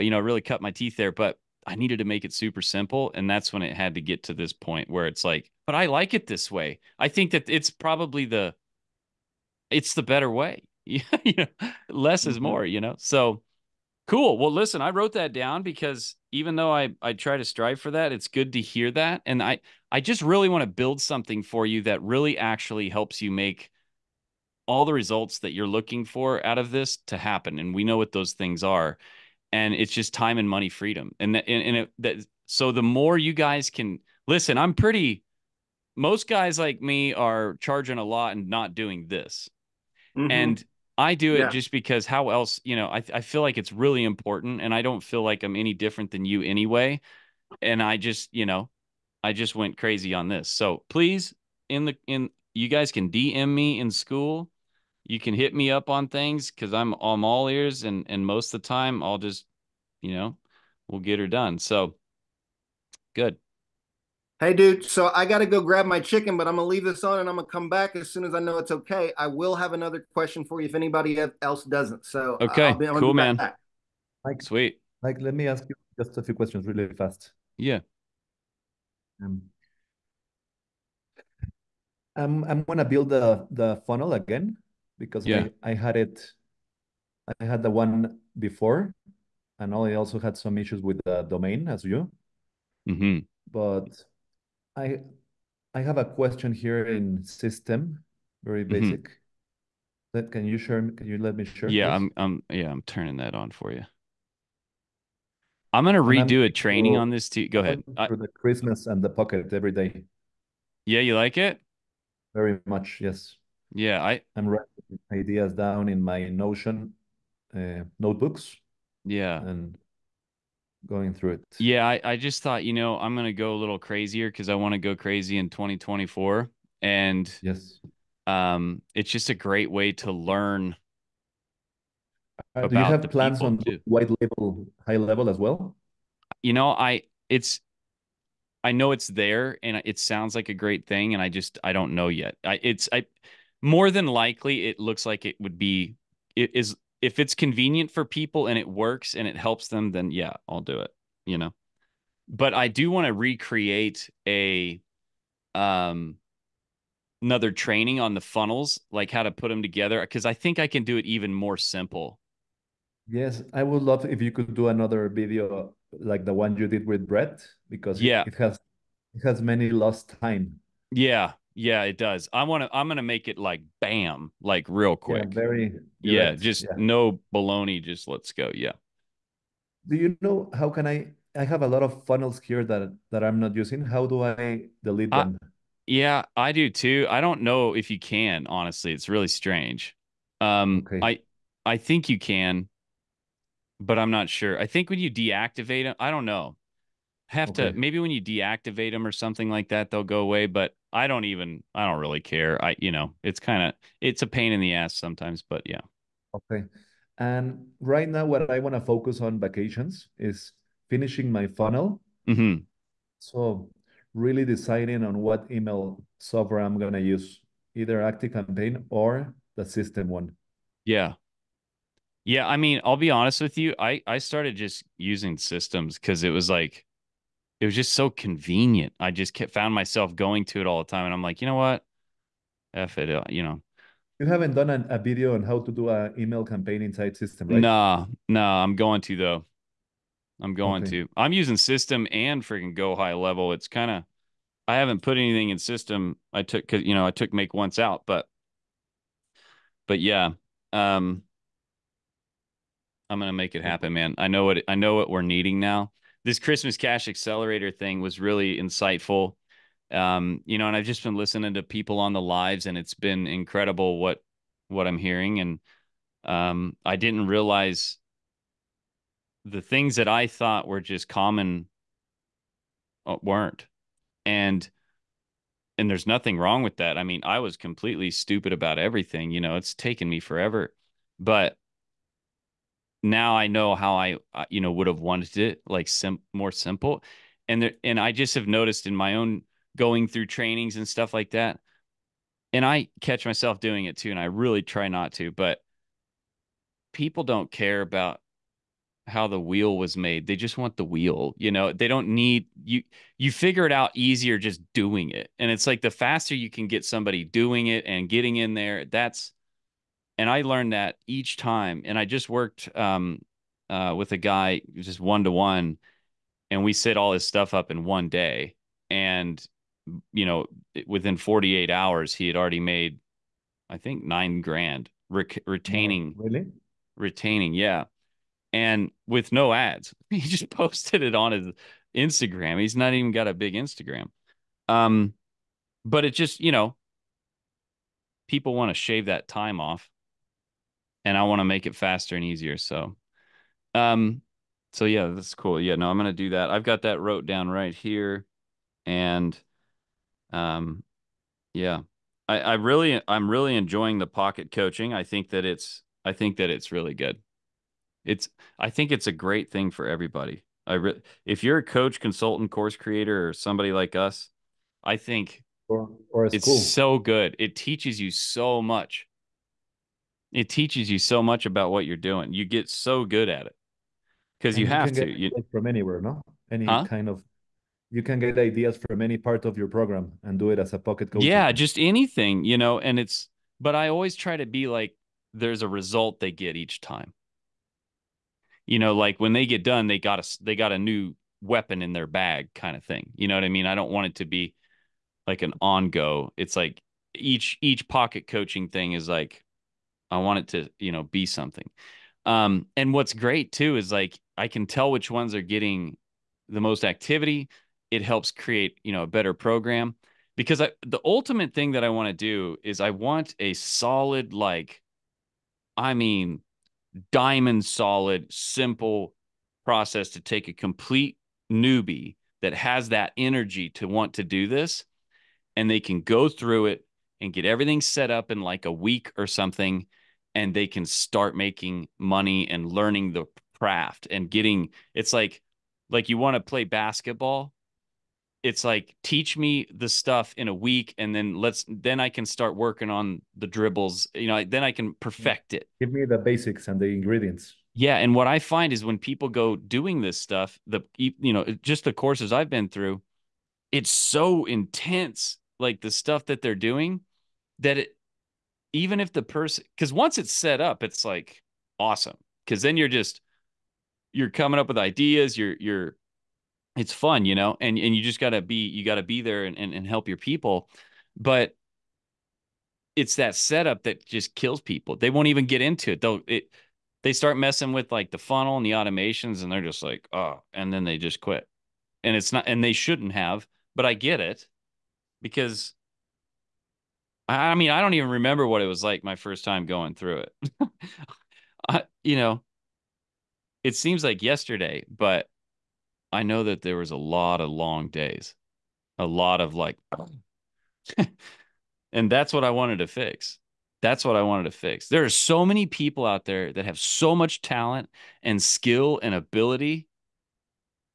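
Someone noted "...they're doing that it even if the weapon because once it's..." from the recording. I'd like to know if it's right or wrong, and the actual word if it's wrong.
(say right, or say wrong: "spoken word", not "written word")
wrong: "person", not "weapon".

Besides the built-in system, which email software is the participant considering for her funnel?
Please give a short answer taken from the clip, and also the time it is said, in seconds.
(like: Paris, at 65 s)
Active Campaign, at 218 s.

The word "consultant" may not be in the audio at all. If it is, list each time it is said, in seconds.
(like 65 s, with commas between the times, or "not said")
362 s.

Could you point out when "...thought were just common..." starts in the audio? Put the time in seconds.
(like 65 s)
270 s.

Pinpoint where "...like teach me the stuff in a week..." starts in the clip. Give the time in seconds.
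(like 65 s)
438 s.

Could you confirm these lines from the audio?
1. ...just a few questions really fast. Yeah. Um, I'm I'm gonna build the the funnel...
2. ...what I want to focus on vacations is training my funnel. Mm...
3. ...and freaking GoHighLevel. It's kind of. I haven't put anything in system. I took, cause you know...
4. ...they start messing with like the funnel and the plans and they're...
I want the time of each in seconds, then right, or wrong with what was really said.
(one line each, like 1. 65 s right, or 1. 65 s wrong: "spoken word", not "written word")
1. 76 s right
2. 208 s wrong: "finishing", not "training"
3. 242 s right
4. 477 s wrong: "automations", not "plans".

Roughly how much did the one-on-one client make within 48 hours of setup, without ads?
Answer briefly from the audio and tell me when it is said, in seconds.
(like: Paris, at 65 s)
nine grand, at 324 s.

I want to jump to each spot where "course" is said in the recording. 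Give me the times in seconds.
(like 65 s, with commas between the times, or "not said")
362 s, 451 s.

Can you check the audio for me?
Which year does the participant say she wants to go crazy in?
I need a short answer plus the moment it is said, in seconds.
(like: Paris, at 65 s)
2024, at 125 s.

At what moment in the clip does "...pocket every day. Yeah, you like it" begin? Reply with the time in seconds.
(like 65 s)
109 s.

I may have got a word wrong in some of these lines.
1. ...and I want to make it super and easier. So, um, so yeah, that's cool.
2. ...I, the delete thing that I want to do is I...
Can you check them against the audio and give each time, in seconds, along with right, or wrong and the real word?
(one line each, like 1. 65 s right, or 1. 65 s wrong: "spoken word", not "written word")
1. 341 s wrong: "faster", not "super"
2. 410 s wrong: "ultimate", not "delete".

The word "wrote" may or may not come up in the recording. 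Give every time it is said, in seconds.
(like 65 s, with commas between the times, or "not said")
14 s, 347 s.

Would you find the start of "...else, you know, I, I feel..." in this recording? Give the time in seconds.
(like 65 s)
42 s.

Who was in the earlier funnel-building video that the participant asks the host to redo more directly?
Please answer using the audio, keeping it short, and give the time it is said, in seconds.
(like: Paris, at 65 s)
Brett, at 167 s.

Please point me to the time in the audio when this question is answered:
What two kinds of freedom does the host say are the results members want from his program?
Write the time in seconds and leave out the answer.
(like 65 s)
30 s.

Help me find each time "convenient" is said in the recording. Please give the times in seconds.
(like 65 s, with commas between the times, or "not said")
147 s, 228 s.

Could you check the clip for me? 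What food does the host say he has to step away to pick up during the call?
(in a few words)
chicken.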